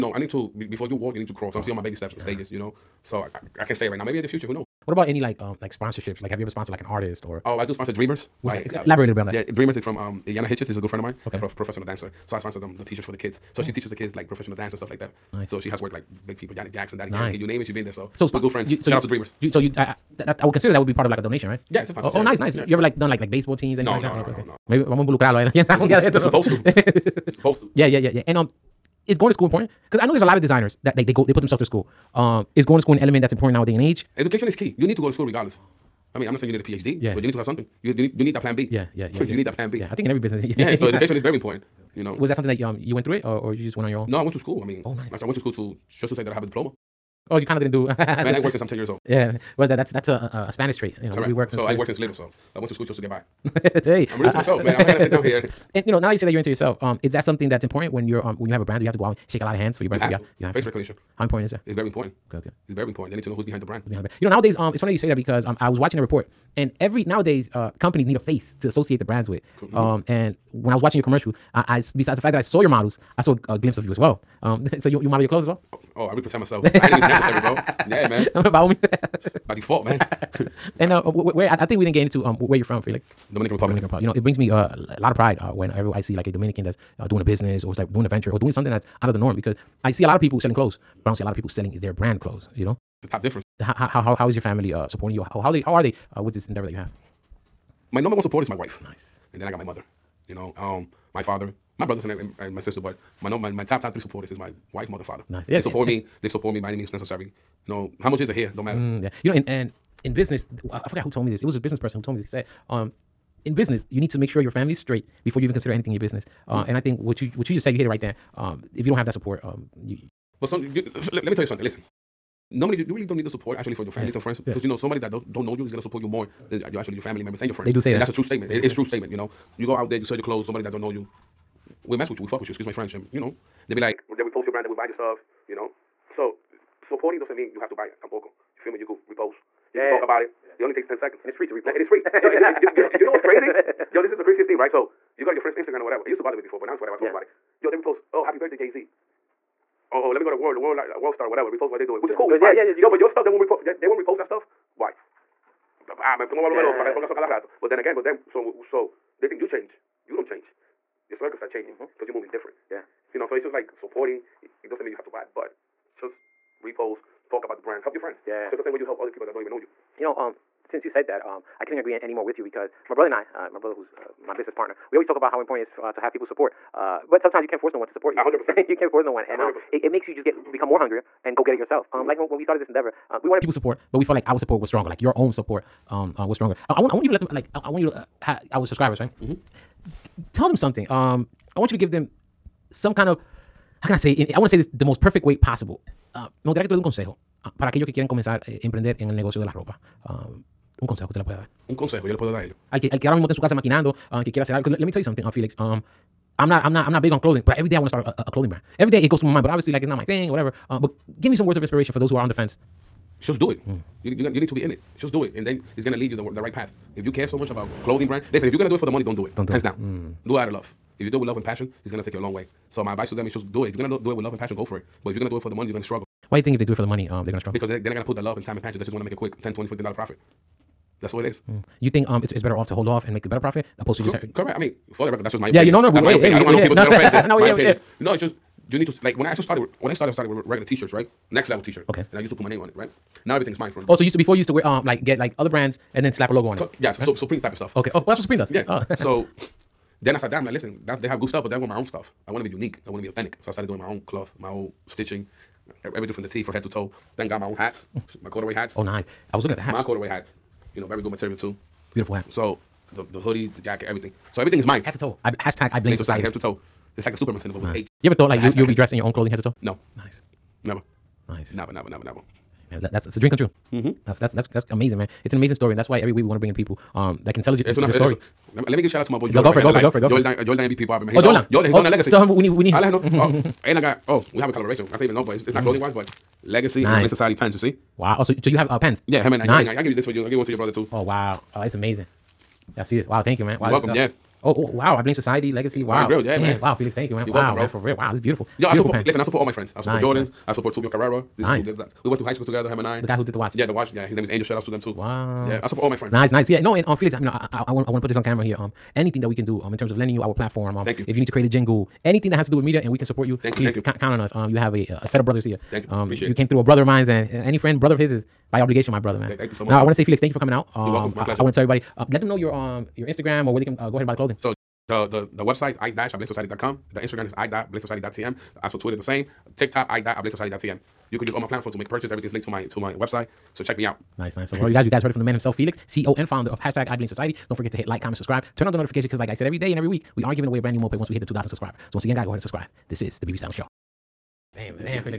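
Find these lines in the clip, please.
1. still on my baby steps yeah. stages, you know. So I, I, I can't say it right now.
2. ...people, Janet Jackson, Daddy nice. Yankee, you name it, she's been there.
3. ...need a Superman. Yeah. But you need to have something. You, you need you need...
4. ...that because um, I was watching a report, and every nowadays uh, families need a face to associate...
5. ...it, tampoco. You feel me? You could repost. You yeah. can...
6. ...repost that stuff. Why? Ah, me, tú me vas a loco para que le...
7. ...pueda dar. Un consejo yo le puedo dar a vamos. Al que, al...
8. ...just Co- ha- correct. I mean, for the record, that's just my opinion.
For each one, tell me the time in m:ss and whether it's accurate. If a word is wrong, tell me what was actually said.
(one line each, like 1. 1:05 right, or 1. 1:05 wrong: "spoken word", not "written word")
1. 0:01 right
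2. 0:16 right
3. 0:36 wrong: "PhD", not "Superman"
4. 1:05 wrong: "companies", not "families"
5. 2:17 right
6. 2:33 right
7. 3:21 wrong: "ellos", not "vamos"
8. 3:54 right.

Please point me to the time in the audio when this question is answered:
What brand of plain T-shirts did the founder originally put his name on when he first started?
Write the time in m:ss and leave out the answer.
4:01.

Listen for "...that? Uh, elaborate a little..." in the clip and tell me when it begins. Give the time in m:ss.
0:08.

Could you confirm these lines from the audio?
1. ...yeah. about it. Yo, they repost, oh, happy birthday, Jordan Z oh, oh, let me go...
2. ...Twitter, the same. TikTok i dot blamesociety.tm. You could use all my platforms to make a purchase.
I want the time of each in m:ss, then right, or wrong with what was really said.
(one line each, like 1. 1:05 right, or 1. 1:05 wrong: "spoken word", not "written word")
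1. 2:27 wrong: "Jay", not "Jordan"
2. 5:28 right.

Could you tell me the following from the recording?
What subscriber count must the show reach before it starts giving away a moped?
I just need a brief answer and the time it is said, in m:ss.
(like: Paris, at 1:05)
2,000, at 5:41.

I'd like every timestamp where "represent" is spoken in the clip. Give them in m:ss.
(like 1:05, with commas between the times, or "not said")
1:16.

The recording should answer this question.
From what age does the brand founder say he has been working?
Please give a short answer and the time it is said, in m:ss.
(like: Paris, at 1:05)
10, at 0:48.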